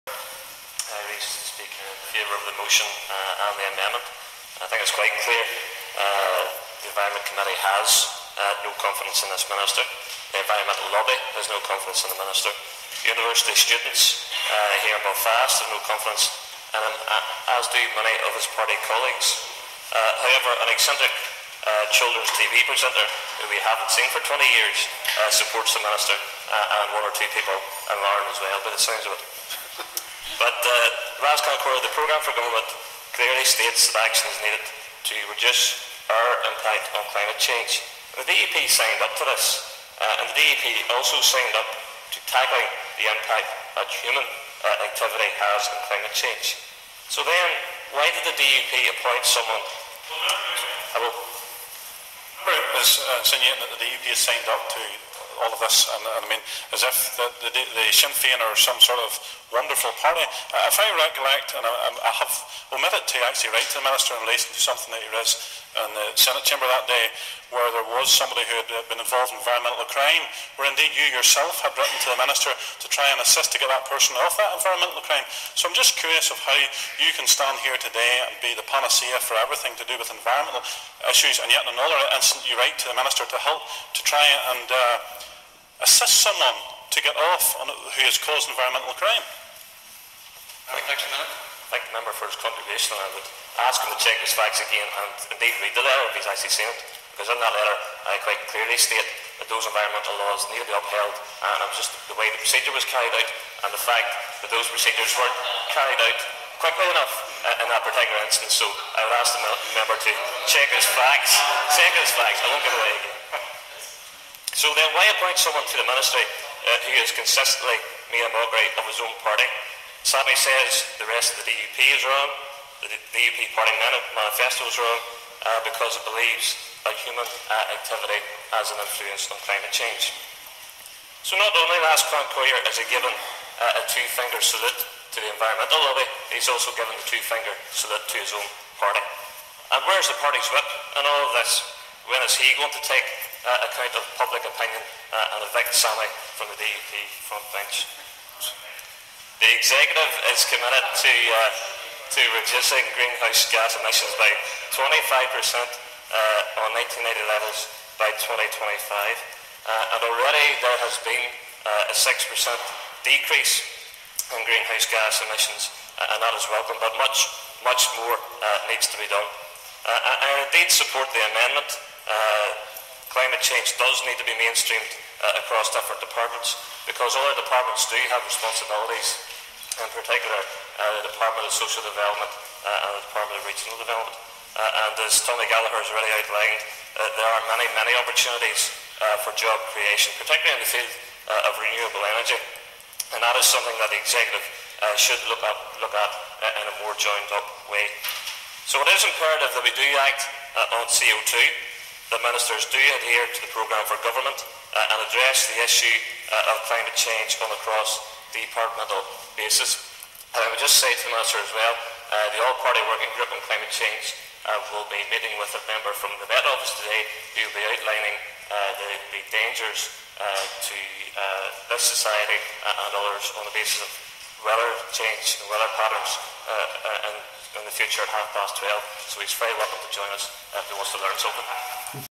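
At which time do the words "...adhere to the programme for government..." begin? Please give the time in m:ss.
3:22.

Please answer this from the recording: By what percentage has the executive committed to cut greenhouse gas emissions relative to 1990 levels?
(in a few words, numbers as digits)
25%.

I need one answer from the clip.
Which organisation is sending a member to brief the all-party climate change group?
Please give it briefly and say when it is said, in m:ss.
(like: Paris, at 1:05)
Met Office, at 3:36.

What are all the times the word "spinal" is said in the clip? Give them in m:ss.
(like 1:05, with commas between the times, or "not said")
not said.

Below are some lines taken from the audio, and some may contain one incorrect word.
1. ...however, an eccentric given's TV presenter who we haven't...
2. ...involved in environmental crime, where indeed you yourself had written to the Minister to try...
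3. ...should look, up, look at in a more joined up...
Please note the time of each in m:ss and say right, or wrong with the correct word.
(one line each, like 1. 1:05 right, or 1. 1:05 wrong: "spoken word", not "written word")
1. 0:20 wrong: "children", not "given"
2. 1:08 right
3. 3:14 right.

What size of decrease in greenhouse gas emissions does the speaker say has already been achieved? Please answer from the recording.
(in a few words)
6%.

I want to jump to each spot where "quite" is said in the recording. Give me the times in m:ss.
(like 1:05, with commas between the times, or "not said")
0:04, 1:38.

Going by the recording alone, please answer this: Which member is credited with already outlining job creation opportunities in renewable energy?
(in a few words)
Tommy Gallagher.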